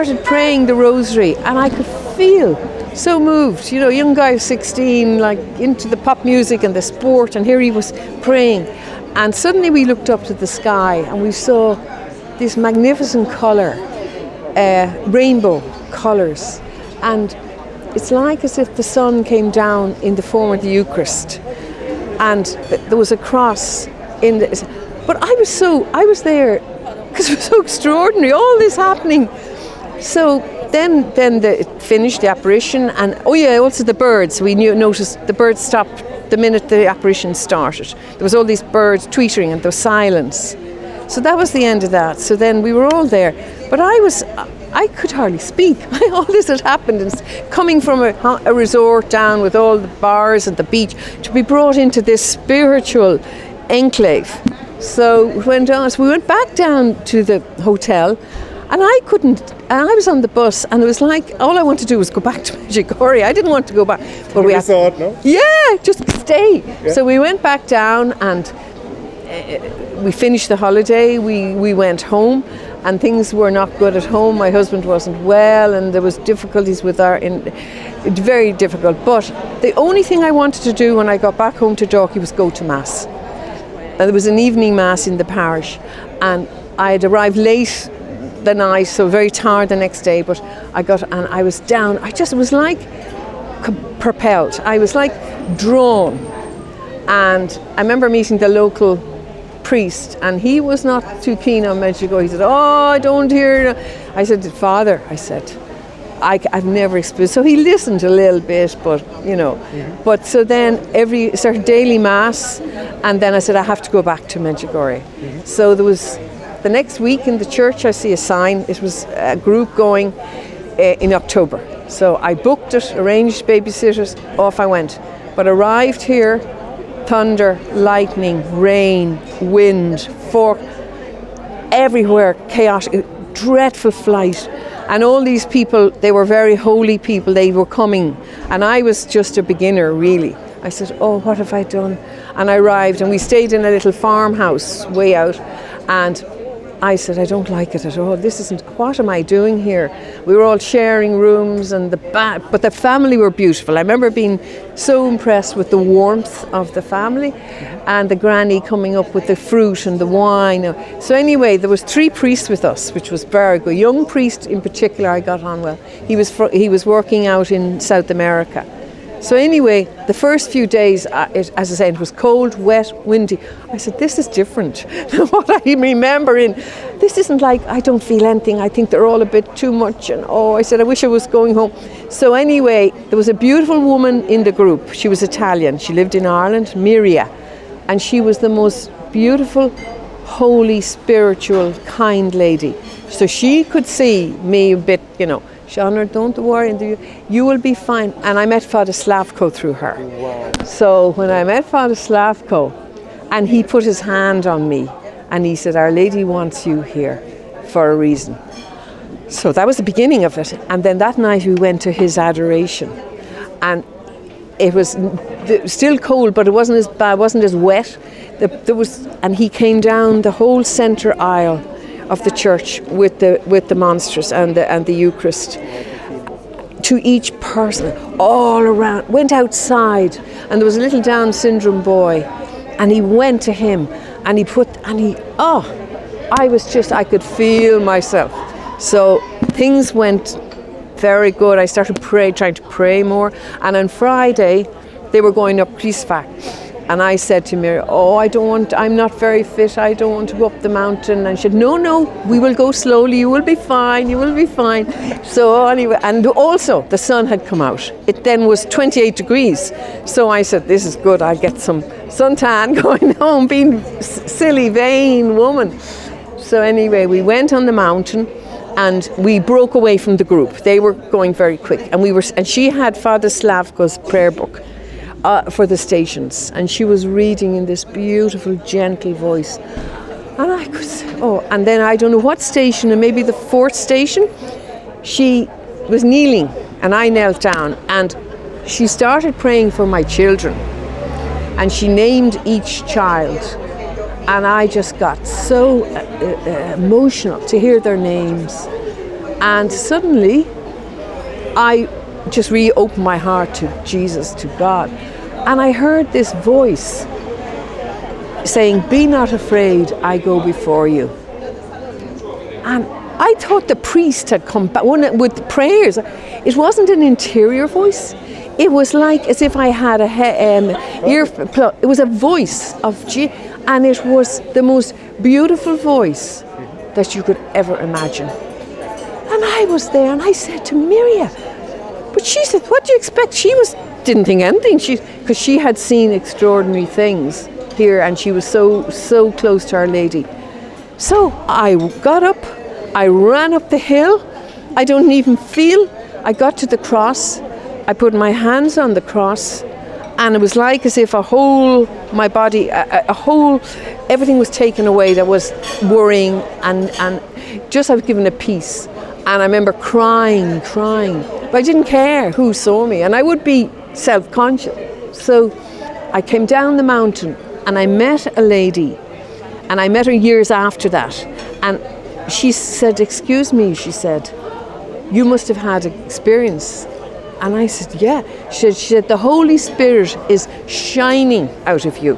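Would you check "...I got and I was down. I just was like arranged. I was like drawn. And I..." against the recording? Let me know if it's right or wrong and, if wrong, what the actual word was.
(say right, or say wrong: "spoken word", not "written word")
wrong: "propelled", not "arranged".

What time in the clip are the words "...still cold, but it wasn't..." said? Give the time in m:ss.
3:35.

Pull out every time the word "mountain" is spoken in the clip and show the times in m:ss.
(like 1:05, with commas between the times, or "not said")
4:10, 4:27, 6:06.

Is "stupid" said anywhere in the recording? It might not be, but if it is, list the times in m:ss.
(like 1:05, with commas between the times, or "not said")
not said.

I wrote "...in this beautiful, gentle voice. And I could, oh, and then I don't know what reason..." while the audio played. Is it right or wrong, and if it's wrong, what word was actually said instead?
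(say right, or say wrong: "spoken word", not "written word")
wrong: "station", not "reason".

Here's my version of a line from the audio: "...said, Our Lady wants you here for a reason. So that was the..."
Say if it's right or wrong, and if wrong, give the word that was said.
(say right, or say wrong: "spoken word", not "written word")
right.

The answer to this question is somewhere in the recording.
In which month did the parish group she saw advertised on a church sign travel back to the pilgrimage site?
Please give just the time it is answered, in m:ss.
2:01.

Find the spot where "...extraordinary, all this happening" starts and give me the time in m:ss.
0:27.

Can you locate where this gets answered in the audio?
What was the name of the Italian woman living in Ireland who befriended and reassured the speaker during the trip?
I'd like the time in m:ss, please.
3:06.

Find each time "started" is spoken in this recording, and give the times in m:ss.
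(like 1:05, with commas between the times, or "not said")
0:37, 4:01, 4:48.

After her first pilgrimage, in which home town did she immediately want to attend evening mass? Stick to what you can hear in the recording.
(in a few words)
Dalkey.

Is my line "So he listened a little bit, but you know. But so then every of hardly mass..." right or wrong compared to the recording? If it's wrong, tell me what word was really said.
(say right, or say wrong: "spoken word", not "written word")
wrong: "daily", not "hardly".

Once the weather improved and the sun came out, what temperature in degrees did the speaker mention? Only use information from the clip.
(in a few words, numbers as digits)
28.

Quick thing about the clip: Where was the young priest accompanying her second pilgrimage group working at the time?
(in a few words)
South America.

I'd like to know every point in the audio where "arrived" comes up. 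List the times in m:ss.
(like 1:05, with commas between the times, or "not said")
1:27, 2:05, 2:22.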